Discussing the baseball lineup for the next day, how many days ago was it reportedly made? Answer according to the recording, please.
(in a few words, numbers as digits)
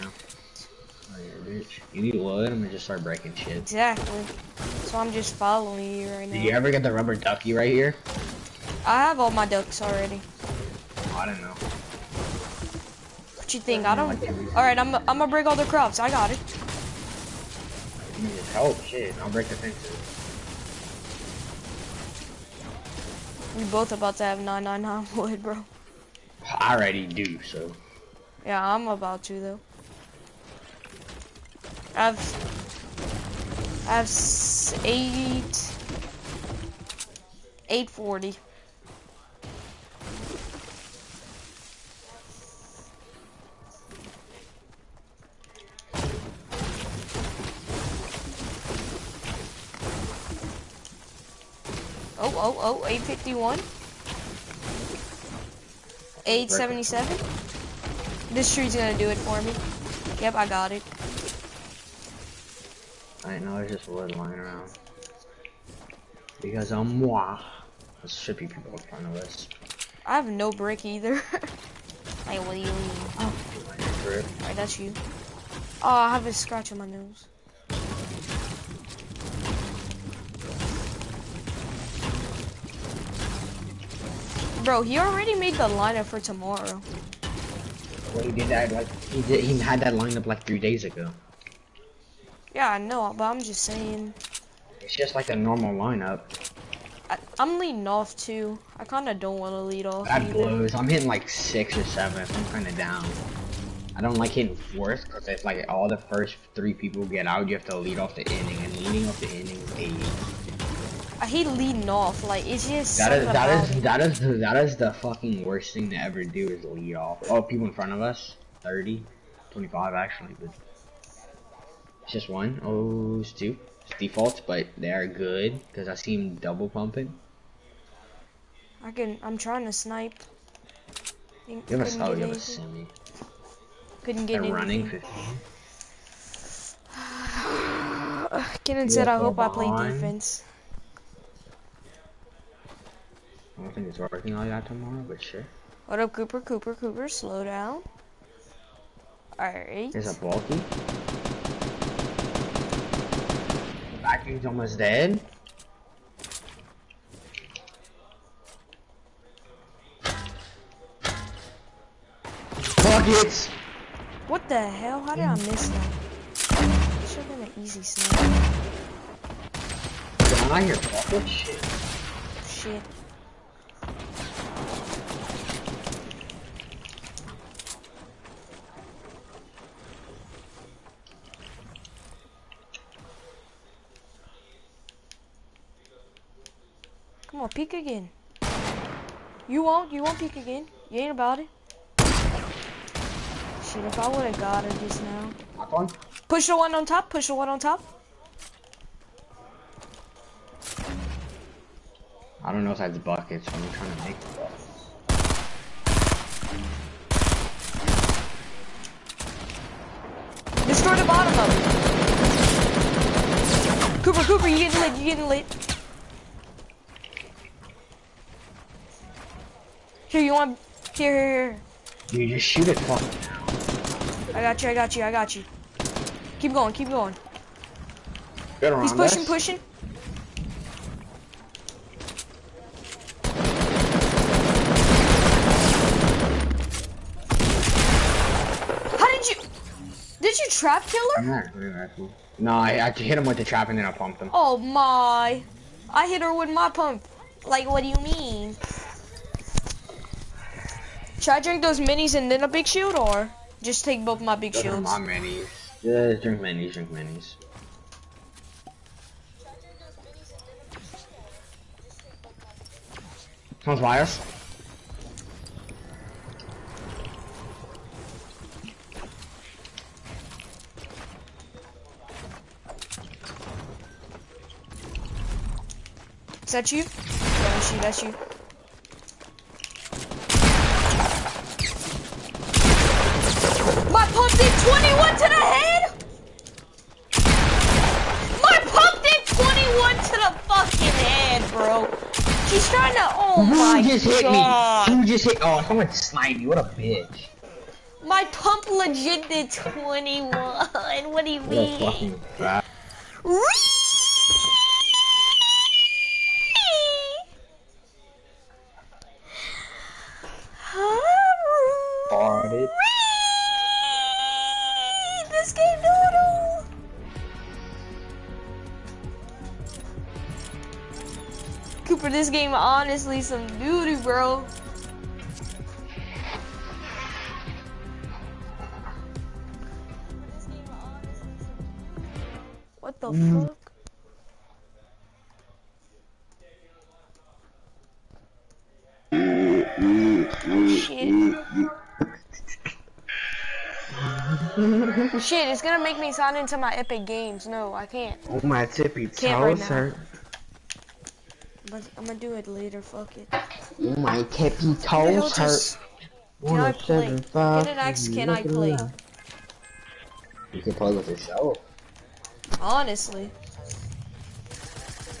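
3 days.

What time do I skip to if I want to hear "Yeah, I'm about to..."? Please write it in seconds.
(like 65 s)
28 s.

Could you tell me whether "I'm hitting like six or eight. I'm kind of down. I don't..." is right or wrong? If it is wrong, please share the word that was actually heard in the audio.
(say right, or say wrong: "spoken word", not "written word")
wrong: "seven", not "eight".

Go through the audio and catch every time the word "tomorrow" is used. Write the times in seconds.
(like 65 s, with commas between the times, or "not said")
86 s, 144 s.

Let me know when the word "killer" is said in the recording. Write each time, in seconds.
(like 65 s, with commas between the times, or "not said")
240 s.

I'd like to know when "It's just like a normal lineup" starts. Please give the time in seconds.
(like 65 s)
94 s.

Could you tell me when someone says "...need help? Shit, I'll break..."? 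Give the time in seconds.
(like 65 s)
18 s.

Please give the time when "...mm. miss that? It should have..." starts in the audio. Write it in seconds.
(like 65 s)
165 s.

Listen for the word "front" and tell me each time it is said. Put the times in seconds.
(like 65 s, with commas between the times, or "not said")
117 s.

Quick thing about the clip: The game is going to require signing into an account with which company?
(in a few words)
Epic Games.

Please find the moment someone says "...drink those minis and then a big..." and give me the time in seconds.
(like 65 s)
251 s.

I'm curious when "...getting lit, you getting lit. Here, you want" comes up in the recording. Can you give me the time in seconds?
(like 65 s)
214 s.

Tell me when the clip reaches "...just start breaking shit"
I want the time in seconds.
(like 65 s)
2 s.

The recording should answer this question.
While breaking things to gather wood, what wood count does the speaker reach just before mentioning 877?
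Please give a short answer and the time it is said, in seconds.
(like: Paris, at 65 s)
851, at 52 s.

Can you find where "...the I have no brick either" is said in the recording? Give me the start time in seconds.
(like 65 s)
69 s.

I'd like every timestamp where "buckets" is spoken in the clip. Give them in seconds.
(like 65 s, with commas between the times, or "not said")
162 s, 170 s, 203 s.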